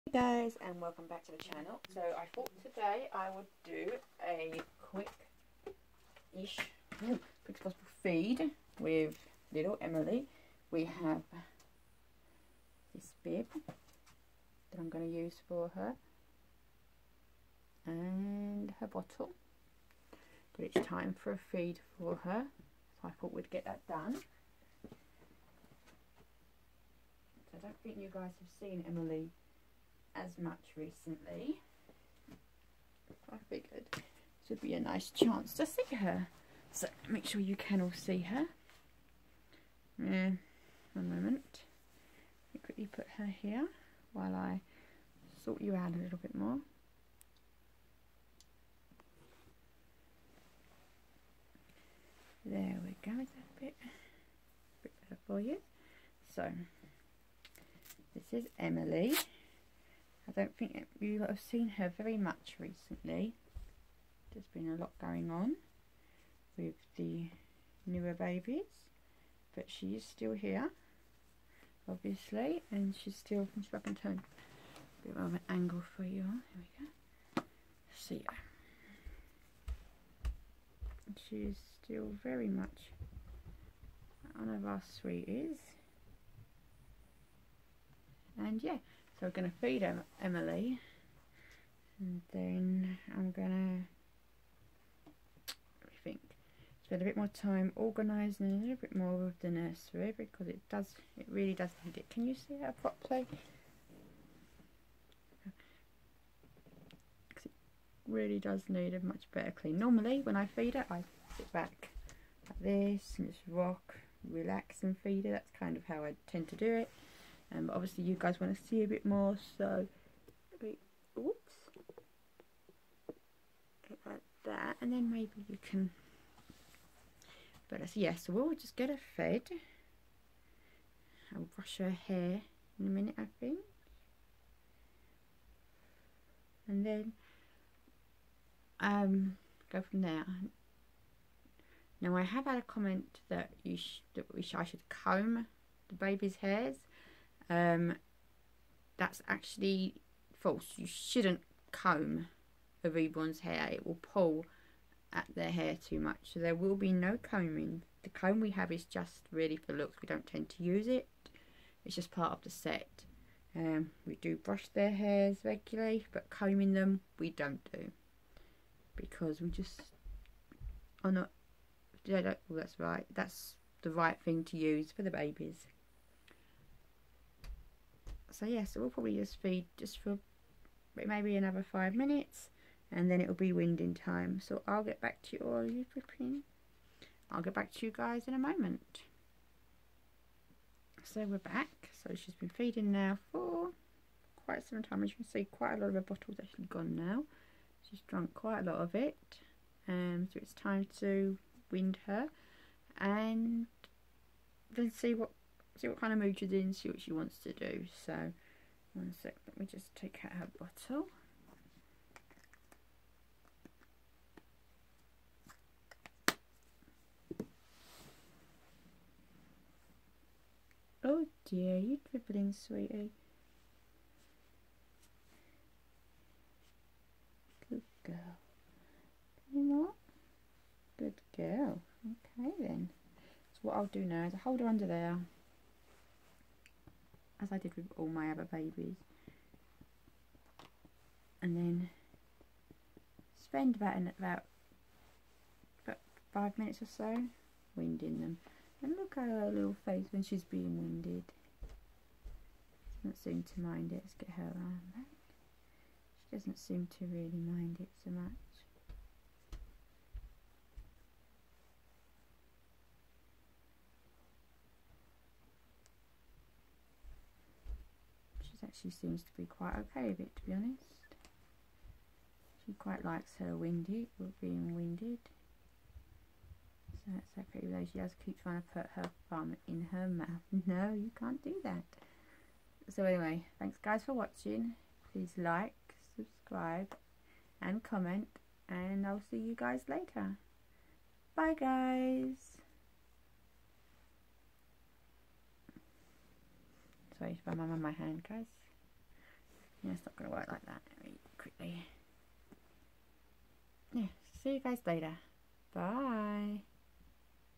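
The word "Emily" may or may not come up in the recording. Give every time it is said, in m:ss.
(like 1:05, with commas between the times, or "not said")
0:09, 0:28, 0:58, 1:30.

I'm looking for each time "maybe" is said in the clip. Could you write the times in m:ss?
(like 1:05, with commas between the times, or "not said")
2:05, 3:00.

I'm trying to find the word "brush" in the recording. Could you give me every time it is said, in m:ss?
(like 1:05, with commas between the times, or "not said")
2:11, 2:44.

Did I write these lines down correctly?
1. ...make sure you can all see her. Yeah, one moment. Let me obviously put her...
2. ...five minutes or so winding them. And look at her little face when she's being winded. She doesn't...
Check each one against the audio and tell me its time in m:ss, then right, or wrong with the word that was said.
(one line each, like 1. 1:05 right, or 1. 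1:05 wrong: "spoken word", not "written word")
1. 0:37 wrong: "quickly", not "obviously"
2. 4:06 right.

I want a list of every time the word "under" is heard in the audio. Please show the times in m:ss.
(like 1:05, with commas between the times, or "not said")
3:54.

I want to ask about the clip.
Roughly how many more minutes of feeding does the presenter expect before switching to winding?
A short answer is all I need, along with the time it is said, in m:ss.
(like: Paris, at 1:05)
5, at 3:01.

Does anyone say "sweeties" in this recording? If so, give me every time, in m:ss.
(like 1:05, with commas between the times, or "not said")
1:25, 3:42.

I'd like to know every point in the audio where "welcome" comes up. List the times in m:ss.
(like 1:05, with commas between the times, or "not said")
0:00.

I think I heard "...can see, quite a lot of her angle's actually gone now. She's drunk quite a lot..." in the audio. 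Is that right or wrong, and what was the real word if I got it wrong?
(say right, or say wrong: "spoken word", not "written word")
wrong: "bottle", not "angle".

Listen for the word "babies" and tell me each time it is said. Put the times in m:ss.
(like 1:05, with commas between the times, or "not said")
1:08, 2:55, 3:58.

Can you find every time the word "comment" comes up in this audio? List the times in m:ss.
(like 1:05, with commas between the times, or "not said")
2:22, 4:47.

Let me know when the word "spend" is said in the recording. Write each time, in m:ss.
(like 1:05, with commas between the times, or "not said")
1:36, 4:03.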